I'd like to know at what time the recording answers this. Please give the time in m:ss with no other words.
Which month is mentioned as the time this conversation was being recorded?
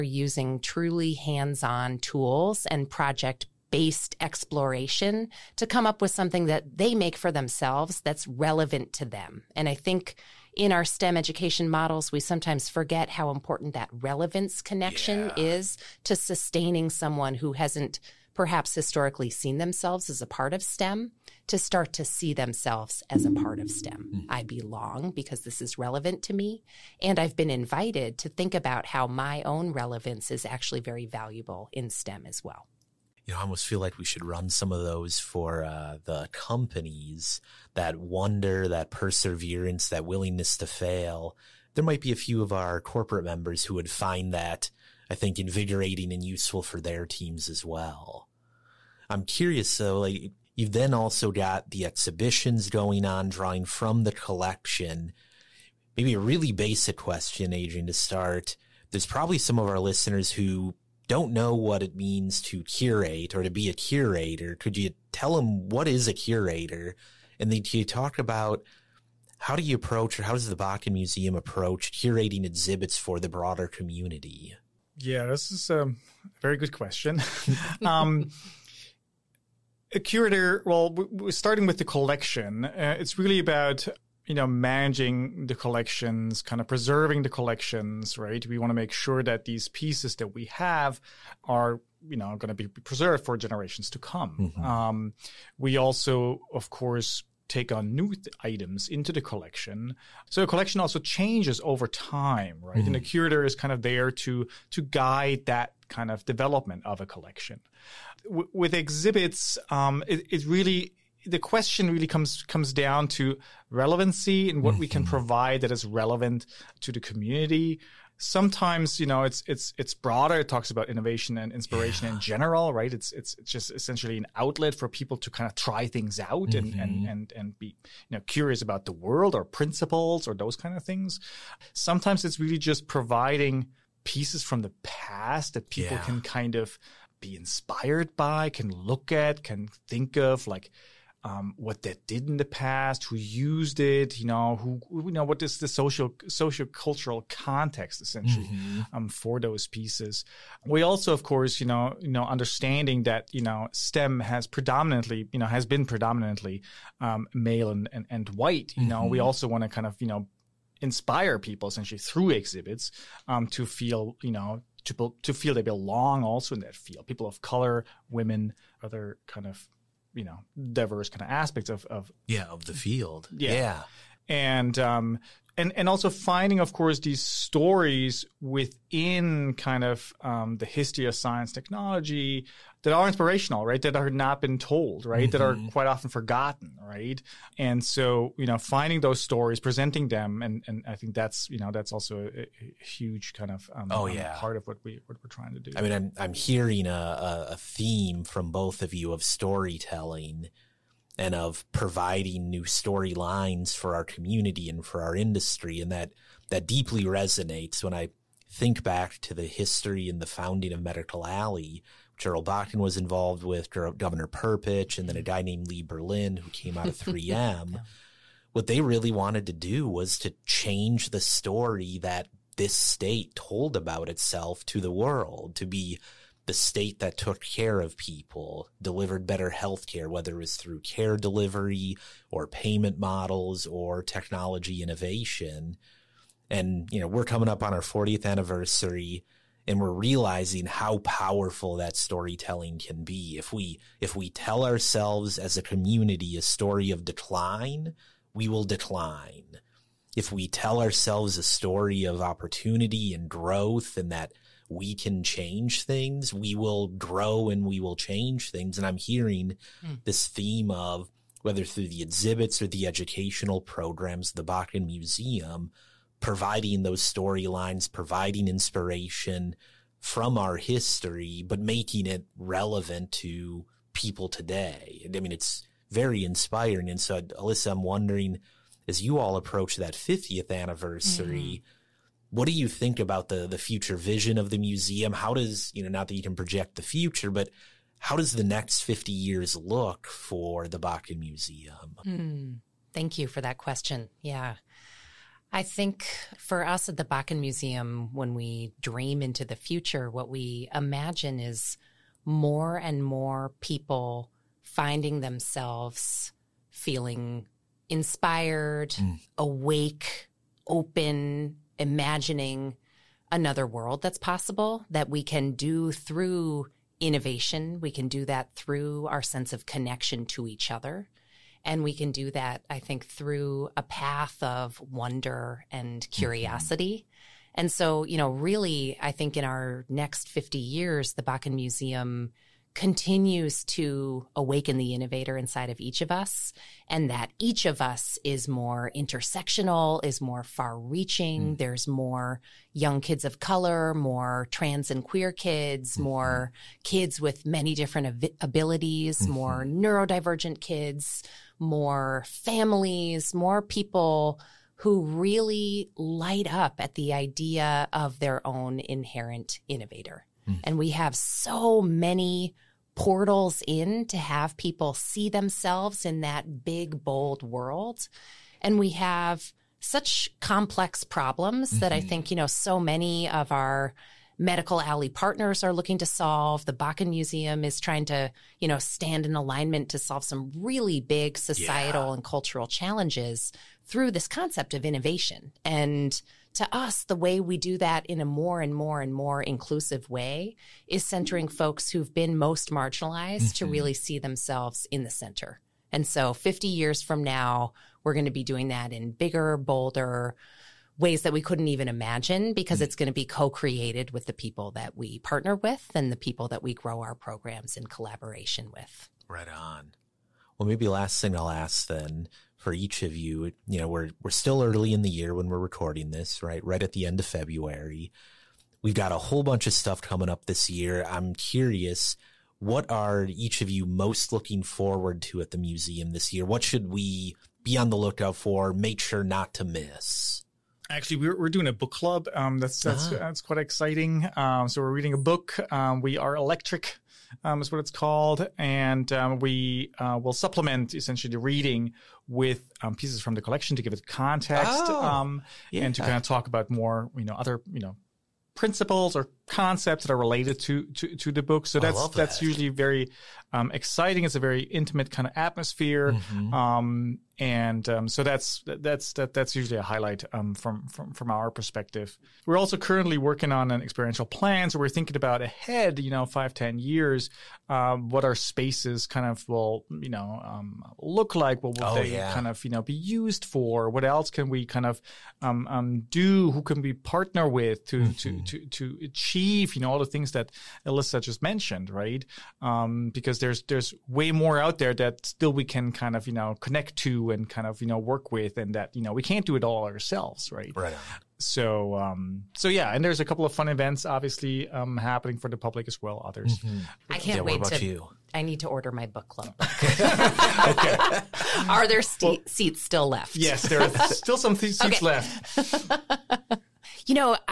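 6:57.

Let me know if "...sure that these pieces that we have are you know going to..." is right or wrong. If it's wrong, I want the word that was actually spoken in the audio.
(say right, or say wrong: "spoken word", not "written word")
right.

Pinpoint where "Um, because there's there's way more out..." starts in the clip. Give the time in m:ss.
8:02.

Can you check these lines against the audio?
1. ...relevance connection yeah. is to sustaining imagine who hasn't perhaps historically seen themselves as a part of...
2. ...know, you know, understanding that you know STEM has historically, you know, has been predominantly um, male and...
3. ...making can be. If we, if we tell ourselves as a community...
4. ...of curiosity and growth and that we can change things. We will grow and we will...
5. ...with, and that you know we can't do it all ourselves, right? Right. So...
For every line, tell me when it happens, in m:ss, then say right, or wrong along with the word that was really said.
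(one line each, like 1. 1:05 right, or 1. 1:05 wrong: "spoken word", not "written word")
1. 0:13 wrong: "someone", not "imagine"
2. 2:31 wrong: "predominantly", not "historically"
3. 4:01 wrong: "storytelling", not "making"
4. 4:12 wrong: "opportunity", not "curiosity"
5. 8:08 right.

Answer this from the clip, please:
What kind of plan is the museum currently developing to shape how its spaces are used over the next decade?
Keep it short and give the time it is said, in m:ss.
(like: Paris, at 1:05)
experiential plan, at 7:43.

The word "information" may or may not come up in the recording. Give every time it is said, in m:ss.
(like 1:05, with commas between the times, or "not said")
not said.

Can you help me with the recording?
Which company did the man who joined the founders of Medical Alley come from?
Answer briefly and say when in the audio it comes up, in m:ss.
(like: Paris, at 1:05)
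3M, at 3:36.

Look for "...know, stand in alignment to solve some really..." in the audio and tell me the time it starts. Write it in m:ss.
6:18.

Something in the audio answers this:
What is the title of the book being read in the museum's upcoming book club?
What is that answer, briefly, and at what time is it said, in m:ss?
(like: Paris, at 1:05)
We Are Electric, at 7:16.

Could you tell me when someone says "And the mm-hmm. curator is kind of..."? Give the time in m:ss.
1:42.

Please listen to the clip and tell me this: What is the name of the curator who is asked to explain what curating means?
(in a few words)
Adrian.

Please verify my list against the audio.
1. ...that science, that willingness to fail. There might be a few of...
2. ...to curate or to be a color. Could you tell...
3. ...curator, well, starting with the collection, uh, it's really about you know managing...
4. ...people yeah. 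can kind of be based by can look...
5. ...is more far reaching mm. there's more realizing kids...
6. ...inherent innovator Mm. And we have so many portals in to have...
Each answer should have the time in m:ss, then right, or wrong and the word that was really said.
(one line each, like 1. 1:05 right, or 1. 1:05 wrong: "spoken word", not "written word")
1. 0:38 wrong: "perseverance", not "science"
2. 1:02 wrong: "curator", not "color"
3. 1:19 right
4. 2:15 wrong: "inspired", not "based"
5. 5:40 wrong: "young", not "realizing"
6. 5:58 right.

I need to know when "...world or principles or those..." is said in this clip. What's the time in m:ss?
2:08.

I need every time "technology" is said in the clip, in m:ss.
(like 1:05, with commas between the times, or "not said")
3:01, 3:54.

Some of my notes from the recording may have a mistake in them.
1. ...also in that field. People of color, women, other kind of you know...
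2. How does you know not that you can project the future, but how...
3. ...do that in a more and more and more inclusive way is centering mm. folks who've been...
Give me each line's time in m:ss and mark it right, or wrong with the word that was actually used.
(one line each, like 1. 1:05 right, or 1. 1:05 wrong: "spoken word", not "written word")
1. 2:46 right
2. 4:45 right
3. 6:27 right.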